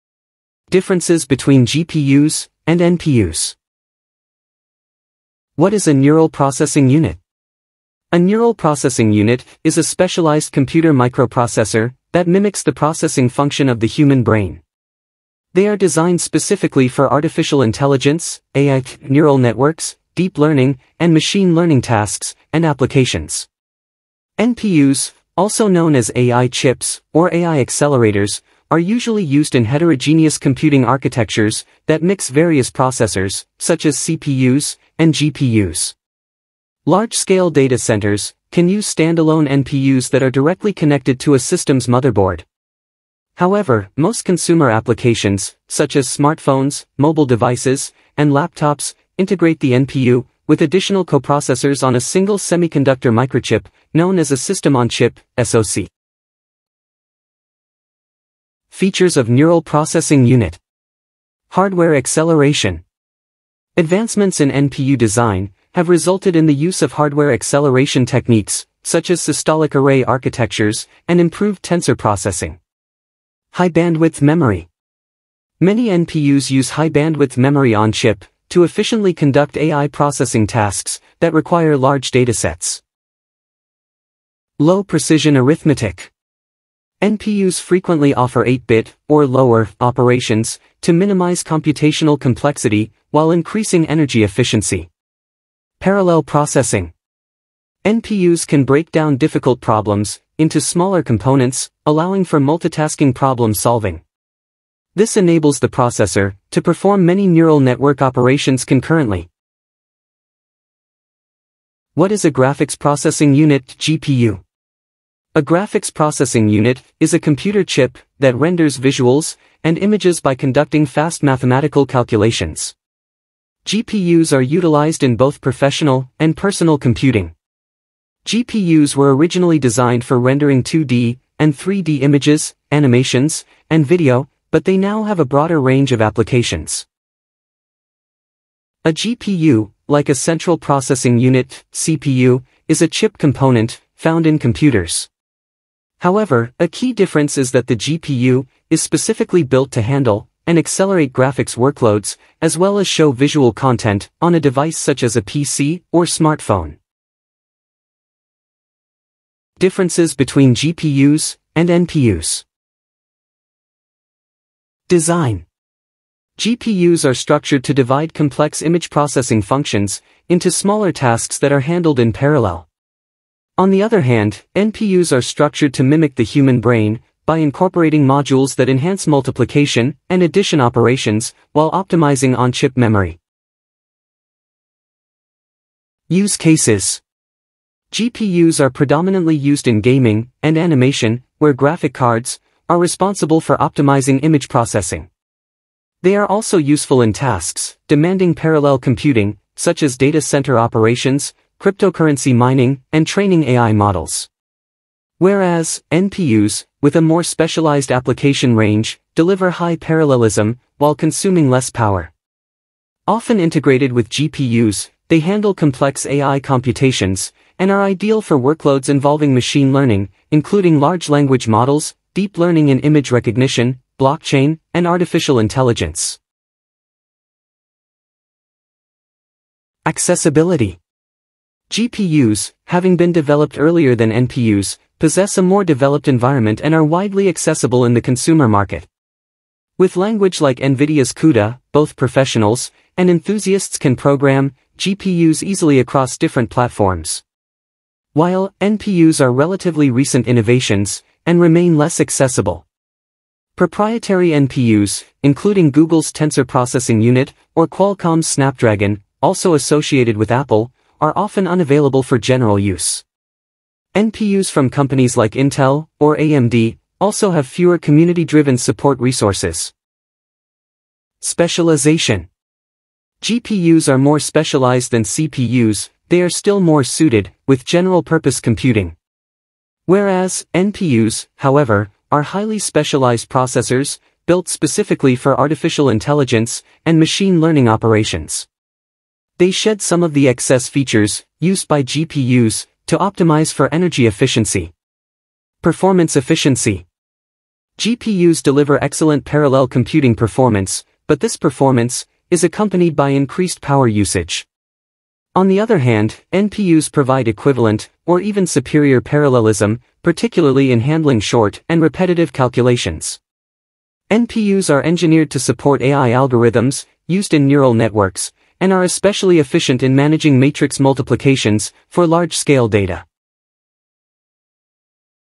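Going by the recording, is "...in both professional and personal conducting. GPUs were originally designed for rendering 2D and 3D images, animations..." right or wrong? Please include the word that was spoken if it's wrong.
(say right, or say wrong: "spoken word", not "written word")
wrong: "computing", not "conducting".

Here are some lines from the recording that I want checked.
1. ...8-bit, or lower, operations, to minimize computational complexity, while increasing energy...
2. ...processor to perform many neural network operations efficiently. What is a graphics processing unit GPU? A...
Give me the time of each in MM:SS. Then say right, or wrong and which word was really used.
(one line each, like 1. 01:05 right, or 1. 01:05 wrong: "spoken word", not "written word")
1. 01:28 right
2. 01:45 wrong: "concurrently", not "efficiently".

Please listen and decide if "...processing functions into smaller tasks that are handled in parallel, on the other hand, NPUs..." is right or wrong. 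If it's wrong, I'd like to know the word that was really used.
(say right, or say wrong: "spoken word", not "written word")
right.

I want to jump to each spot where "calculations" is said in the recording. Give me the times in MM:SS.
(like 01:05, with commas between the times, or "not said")
02:01, 05:12.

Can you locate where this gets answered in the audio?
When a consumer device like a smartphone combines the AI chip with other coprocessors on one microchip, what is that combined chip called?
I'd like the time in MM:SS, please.
00:54.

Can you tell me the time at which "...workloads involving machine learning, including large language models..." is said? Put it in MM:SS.
03:38.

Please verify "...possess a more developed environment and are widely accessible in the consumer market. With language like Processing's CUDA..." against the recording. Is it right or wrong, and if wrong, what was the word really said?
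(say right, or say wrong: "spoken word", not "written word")
wrong: "NVIDIA", not "Processing".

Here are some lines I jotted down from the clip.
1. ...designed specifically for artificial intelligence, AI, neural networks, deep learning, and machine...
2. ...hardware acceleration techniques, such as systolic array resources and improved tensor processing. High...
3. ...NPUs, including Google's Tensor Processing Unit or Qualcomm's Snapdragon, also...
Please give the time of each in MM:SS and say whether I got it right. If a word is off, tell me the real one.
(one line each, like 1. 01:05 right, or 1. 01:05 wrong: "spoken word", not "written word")
1. 00:15 right
2. 01:06 wrong: "architectures", not "resources"
3. 04:14 right.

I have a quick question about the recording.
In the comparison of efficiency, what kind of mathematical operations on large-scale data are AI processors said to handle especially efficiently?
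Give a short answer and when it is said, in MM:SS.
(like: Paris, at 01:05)
matrix multiplications, at 05:20.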